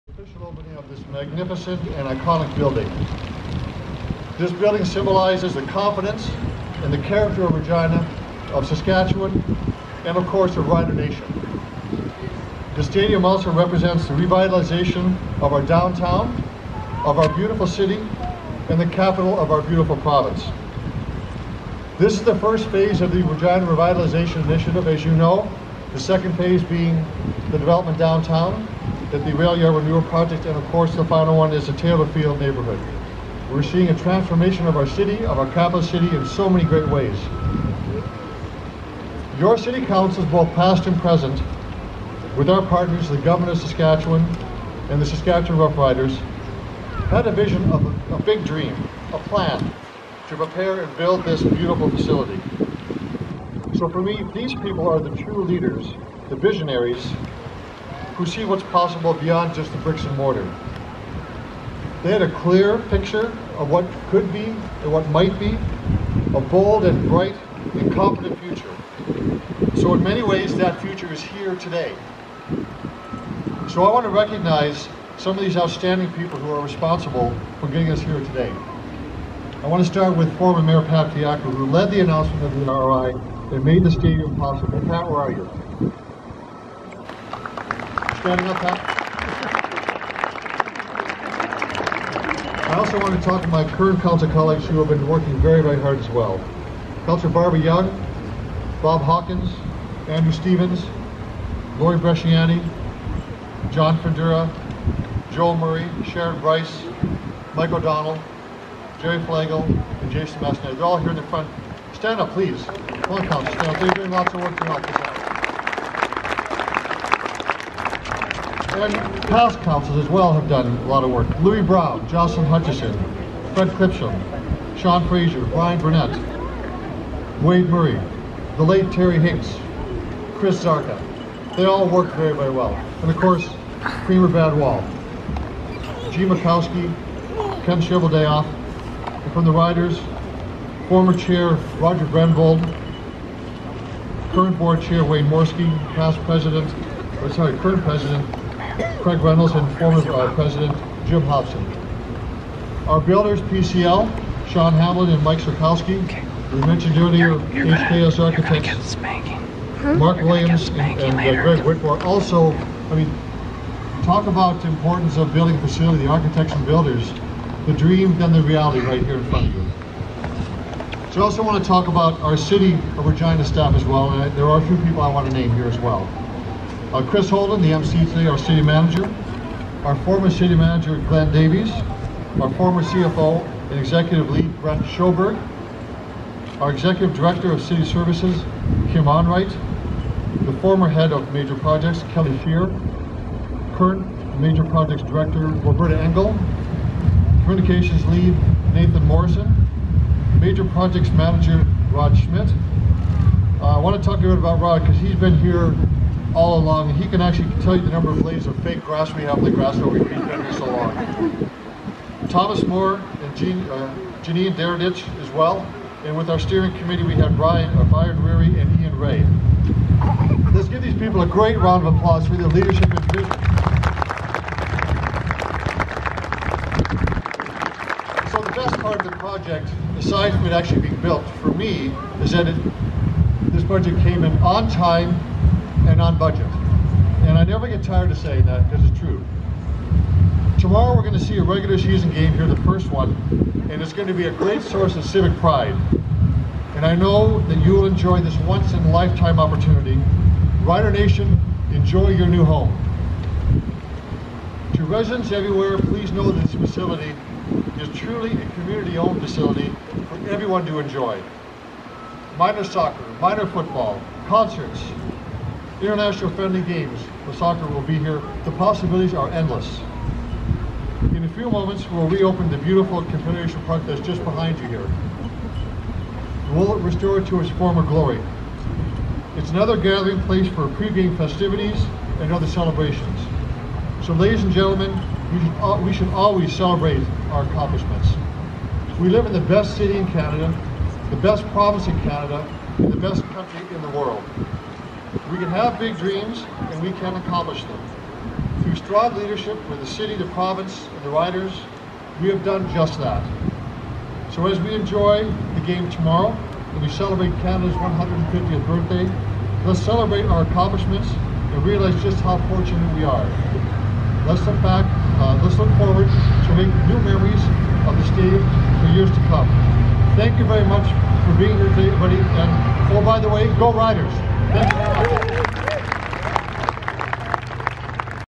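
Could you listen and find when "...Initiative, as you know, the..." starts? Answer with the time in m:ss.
0:24.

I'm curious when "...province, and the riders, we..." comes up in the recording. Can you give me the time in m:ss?
5:00.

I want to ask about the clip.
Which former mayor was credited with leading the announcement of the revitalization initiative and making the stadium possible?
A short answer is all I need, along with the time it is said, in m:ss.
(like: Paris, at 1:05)
Pat Fiacco, at 1:20.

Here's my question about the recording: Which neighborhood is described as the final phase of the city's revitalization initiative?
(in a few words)
Taylor Field.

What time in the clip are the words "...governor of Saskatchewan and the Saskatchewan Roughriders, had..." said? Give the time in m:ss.
0:43.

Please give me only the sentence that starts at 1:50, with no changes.
They're all here in the front.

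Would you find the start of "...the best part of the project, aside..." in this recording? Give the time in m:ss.
3:48.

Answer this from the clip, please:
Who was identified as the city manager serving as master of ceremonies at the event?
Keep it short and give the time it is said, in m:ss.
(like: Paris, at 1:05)
Chris Holden, at 2:57.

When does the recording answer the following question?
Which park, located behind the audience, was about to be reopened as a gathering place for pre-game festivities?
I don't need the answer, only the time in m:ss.
4:33.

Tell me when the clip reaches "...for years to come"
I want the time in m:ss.
5:18.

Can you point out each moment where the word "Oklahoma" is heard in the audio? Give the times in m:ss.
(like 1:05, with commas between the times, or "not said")
not said.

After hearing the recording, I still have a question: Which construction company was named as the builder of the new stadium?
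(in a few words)
PCL.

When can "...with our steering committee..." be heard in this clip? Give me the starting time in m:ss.
3:36.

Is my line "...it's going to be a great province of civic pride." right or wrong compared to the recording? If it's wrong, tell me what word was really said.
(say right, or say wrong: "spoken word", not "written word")
wrong: "source", not "province".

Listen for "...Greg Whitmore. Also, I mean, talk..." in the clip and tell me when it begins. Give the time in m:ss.
2:41.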